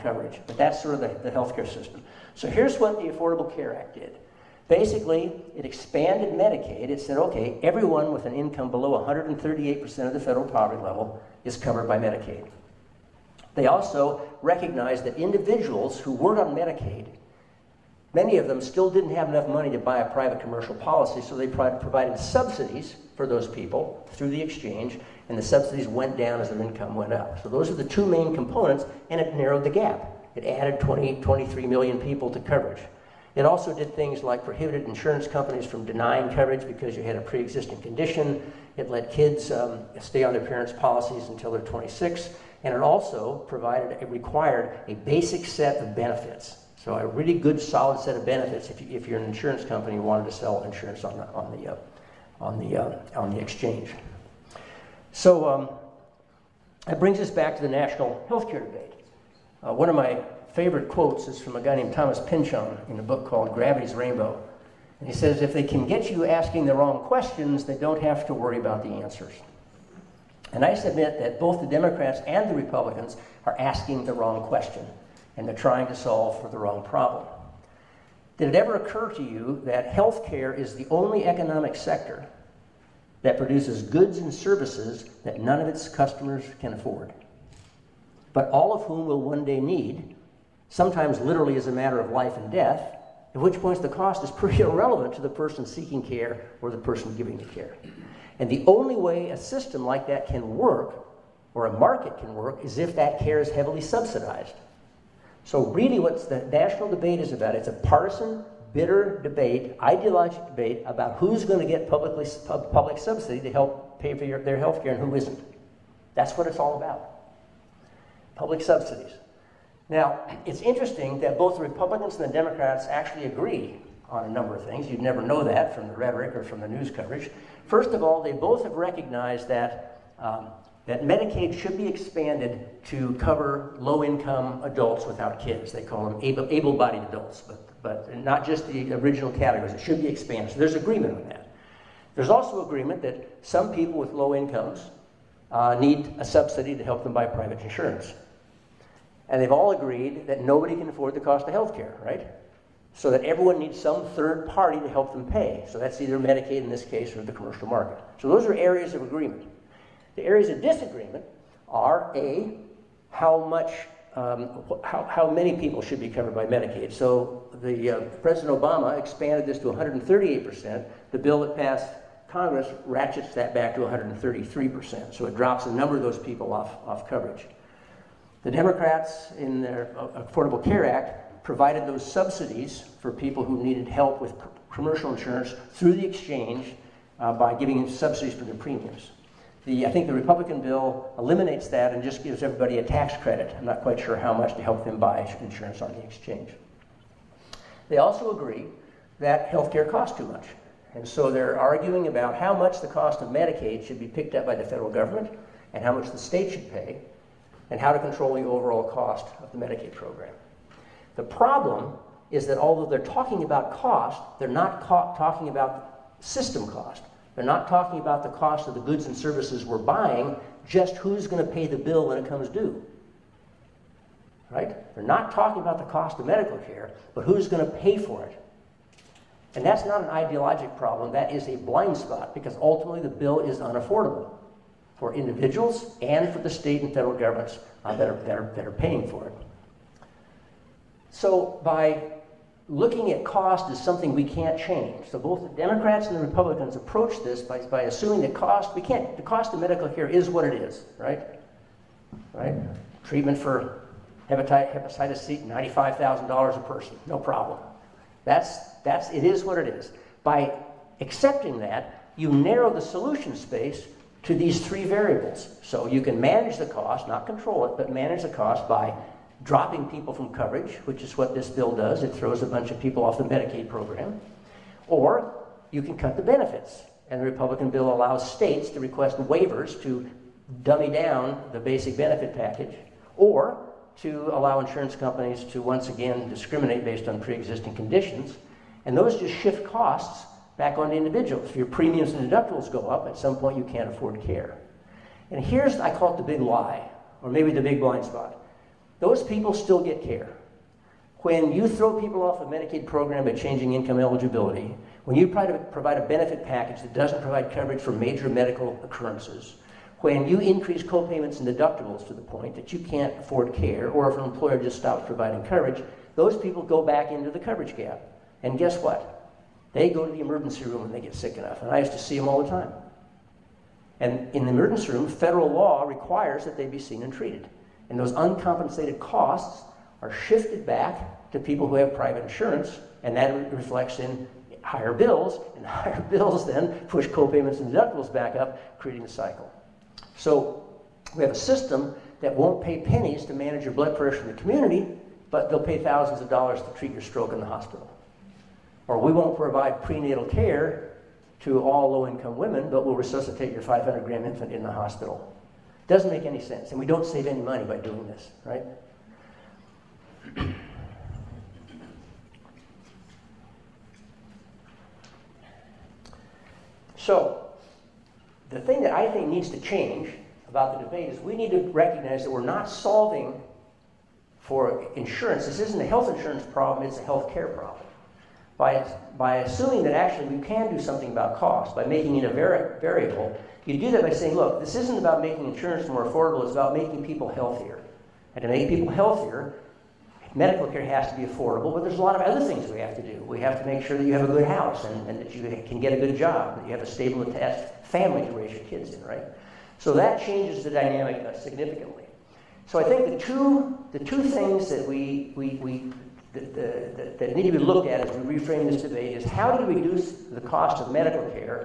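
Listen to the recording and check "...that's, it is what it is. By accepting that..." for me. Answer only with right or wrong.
right.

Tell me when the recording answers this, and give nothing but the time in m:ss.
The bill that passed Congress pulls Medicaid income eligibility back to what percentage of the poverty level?
2:53.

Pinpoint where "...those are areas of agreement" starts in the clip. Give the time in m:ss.
2:38.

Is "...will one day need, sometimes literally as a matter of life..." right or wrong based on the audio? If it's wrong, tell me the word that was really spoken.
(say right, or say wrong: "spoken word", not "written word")
right.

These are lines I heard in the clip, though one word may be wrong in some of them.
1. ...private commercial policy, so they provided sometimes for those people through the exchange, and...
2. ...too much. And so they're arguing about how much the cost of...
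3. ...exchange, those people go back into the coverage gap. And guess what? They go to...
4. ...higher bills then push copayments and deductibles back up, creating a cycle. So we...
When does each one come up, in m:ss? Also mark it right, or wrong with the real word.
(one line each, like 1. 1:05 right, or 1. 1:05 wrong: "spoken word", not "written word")
1. 0:20 wrong: "subsidies", not "sometimes"
2. 3:20 right
3. 5:15 wrong: "coverage", not "exchange"
4. 5:35 right.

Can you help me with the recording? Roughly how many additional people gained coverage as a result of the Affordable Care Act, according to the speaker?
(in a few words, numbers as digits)
23 million.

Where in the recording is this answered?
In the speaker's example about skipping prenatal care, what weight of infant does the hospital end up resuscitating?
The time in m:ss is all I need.
5:53.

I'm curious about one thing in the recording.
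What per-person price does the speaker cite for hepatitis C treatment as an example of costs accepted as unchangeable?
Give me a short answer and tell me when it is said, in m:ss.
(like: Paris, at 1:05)
$95,000, at 4:15.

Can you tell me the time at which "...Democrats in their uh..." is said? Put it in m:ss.
2:58.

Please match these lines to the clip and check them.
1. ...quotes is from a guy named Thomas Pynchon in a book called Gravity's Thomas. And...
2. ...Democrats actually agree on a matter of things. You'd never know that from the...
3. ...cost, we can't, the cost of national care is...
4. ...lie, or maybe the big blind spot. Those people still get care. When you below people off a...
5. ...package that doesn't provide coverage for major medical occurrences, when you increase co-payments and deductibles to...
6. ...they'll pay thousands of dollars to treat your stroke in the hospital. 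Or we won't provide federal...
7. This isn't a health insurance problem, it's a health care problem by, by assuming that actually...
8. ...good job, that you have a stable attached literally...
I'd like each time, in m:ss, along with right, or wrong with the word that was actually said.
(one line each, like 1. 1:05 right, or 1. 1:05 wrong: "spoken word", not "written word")
1. 1:00 wrong: "Rainbow", not "Thomas"
2. 2:02 wrong: "number", not "matter"
3. 4:08 wrong: "medical", not "national"
4. 4:56 wrong: "throw", not "below"
5. 5:06 right
6. 5:45 wrong: "prenatal", not "federal"
7. 6:15 right
8. 6:35 wrong: "family", not "literally".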